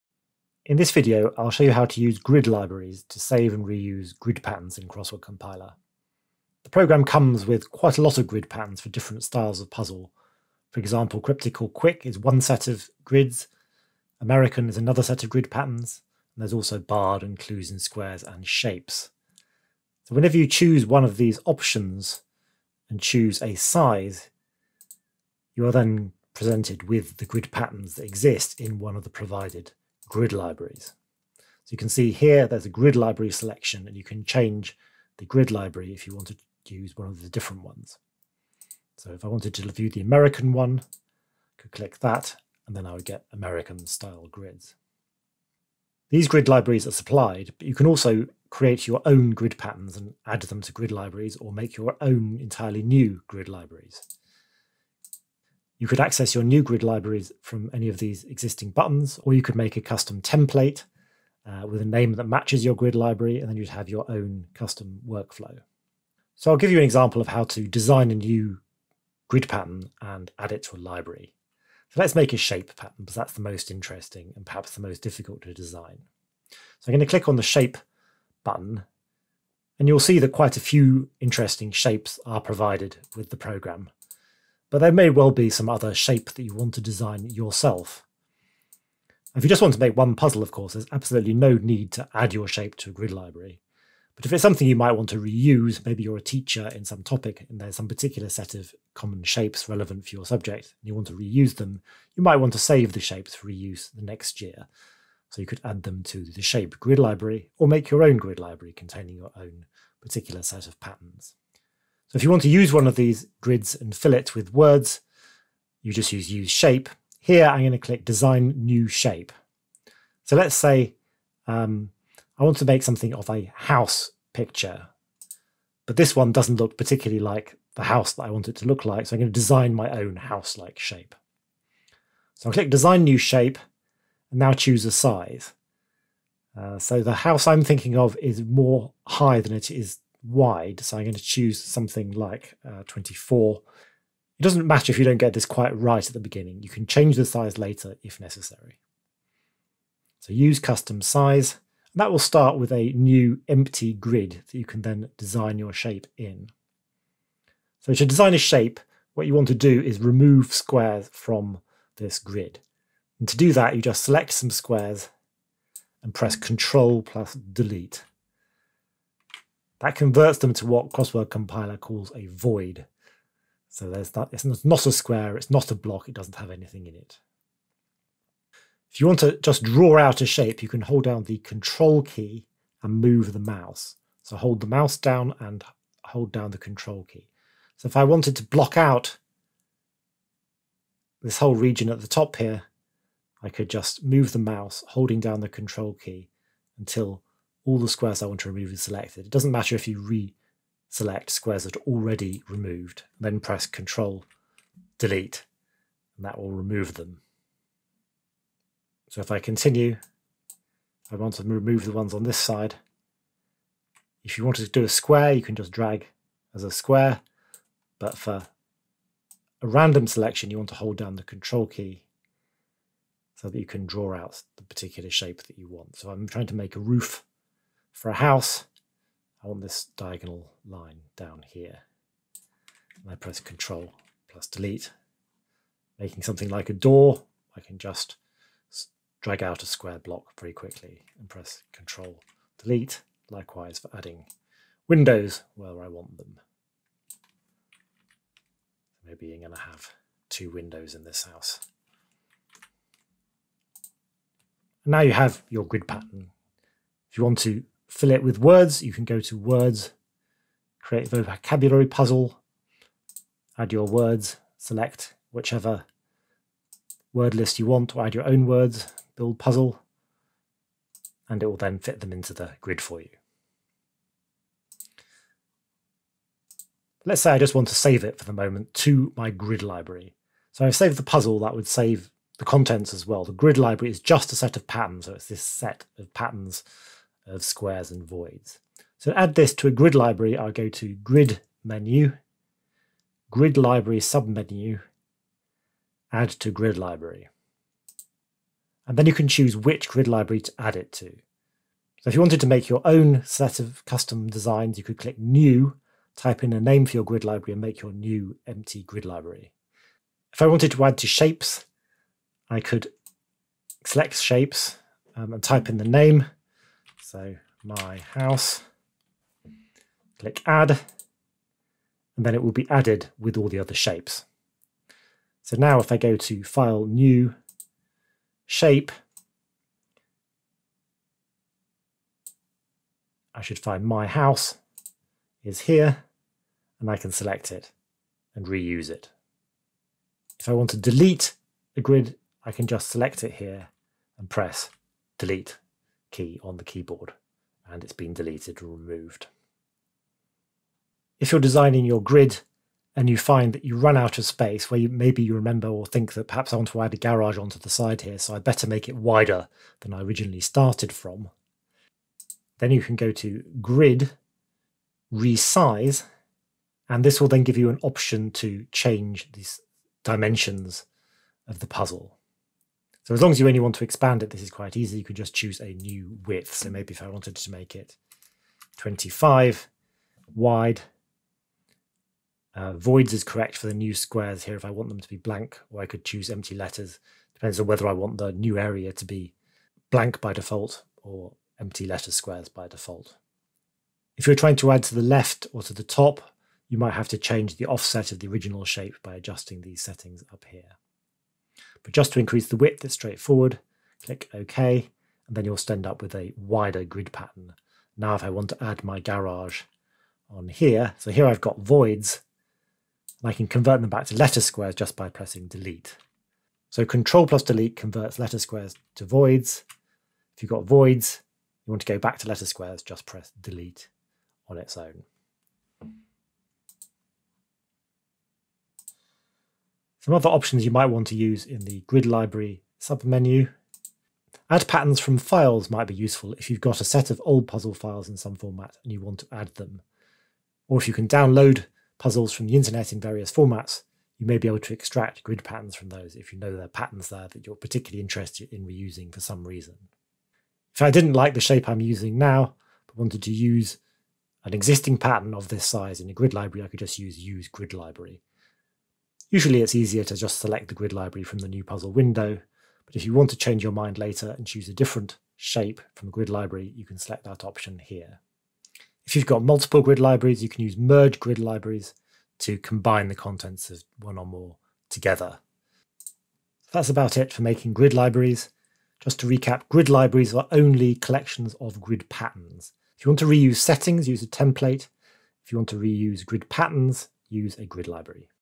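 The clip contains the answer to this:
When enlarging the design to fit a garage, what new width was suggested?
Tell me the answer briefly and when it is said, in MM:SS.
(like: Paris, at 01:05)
25, at 06:18.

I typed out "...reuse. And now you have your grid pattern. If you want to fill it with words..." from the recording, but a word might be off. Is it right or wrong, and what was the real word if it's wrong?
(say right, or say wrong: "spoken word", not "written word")
wrong: "house", not "reuse".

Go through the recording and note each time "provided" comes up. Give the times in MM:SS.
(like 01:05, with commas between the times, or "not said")
00:29, 01:22.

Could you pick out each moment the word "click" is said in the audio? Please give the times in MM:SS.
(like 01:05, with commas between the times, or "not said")
00:41, 01:17, 01:57, 02:12, 05:04, 05:20, 06:44.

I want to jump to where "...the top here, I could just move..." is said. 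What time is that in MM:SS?
03:12.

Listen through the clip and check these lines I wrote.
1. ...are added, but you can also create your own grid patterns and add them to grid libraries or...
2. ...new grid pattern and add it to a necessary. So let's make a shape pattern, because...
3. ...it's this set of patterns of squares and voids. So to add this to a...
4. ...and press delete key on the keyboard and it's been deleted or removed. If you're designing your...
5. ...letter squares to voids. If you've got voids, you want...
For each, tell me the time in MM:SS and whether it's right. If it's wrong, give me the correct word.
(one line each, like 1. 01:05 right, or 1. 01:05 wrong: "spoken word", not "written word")
1. 00:46 wrong: "supplied", not "added"
2. 01:08 wrong: "library", not "necessary"
3. 04:45 right
4. 05:44 right
5. 06:58 right.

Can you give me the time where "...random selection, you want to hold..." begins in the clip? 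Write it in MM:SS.
03:39.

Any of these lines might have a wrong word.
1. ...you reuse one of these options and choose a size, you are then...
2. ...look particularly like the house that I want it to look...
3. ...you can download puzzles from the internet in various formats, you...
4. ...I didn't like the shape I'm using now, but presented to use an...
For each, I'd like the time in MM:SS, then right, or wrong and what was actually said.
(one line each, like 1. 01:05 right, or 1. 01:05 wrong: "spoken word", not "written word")
1. 00:20 wrong: "choose", not "reuse"
2. 02:06 right
3. 07:20 right
4. 07:30 wrong: "wanted", not "presented".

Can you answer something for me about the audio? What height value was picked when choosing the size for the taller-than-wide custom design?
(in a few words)
24.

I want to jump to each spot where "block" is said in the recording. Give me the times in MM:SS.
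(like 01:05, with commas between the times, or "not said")
02:55, 03:08, 03:59.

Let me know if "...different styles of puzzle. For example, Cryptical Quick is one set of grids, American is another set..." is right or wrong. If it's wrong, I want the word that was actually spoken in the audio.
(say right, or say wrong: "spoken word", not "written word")
right.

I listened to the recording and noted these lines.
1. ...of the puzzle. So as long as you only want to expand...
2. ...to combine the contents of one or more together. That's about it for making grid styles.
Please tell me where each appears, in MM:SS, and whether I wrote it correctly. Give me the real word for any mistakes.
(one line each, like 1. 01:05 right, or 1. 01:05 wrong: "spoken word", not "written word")
1. 06:11 right
2. 07:52 wrong: "libraries", not "styles".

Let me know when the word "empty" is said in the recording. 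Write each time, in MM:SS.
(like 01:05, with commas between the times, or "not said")
02:33, 05:08, 06:26, 06:31.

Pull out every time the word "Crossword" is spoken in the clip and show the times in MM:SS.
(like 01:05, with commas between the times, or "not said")
00:04, 02:50.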